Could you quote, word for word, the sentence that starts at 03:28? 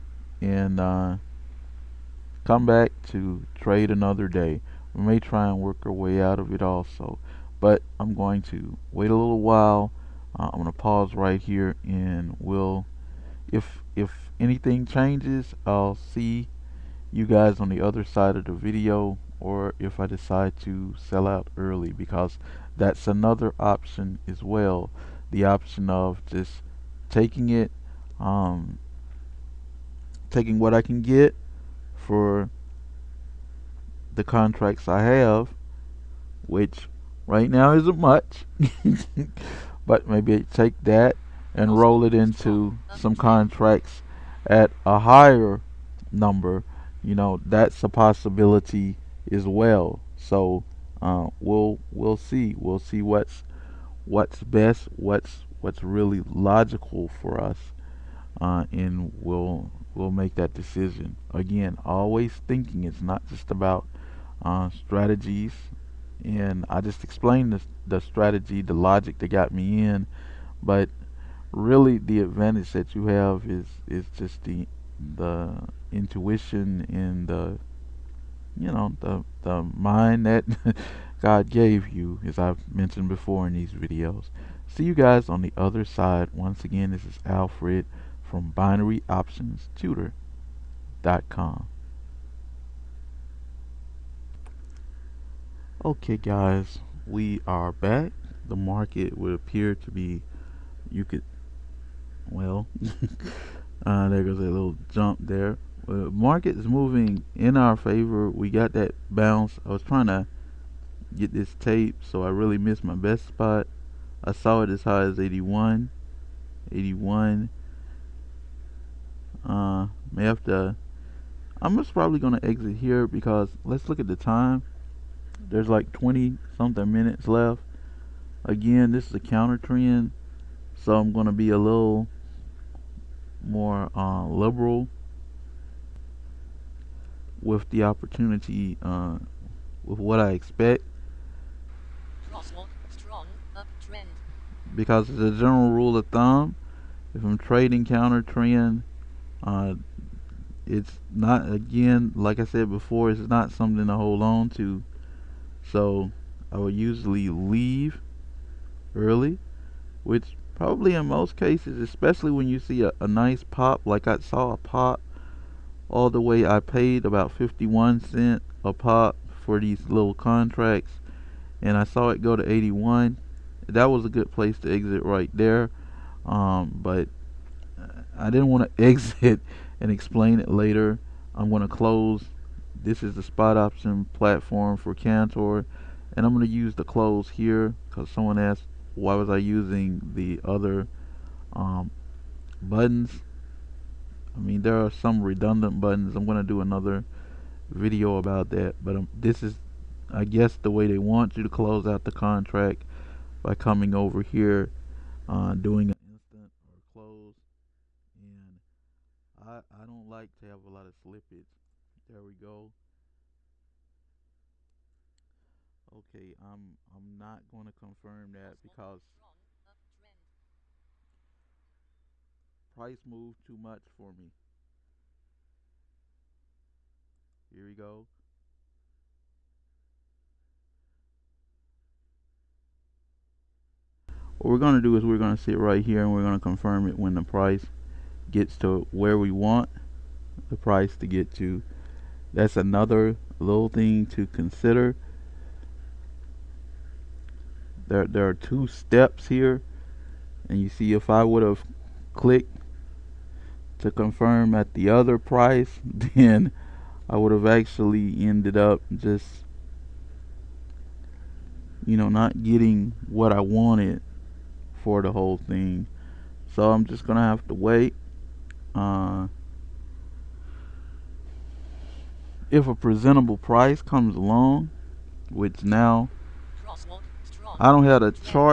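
And I, I don't like to have a lot of slippage.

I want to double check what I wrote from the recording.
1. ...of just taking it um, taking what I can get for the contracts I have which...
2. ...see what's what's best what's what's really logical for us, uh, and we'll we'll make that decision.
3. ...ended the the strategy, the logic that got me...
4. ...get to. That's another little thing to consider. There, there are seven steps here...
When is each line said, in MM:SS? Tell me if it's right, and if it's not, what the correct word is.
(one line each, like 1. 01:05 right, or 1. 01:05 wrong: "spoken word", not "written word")
1. 00:25 right
2. 00:52 right
3. 01:07 wrong: "explained", not "ended"
4. 04:01 wrong: "two", not "seven".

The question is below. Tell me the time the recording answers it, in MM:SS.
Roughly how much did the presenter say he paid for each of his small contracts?
02:47.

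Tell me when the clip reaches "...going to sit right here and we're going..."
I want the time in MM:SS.
03:55.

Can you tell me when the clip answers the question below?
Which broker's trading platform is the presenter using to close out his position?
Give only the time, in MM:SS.
03:04.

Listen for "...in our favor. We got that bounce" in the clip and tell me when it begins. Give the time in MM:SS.
01:47.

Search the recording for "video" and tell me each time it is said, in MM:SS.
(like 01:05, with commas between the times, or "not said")
00:18, 01:23, 03:17.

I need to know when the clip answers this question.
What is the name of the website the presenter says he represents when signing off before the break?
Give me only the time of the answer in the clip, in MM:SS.
01:28.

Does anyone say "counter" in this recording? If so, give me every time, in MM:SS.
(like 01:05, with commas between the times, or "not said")
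02:09, 02:27.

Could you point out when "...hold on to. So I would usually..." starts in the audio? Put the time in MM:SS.
02:33.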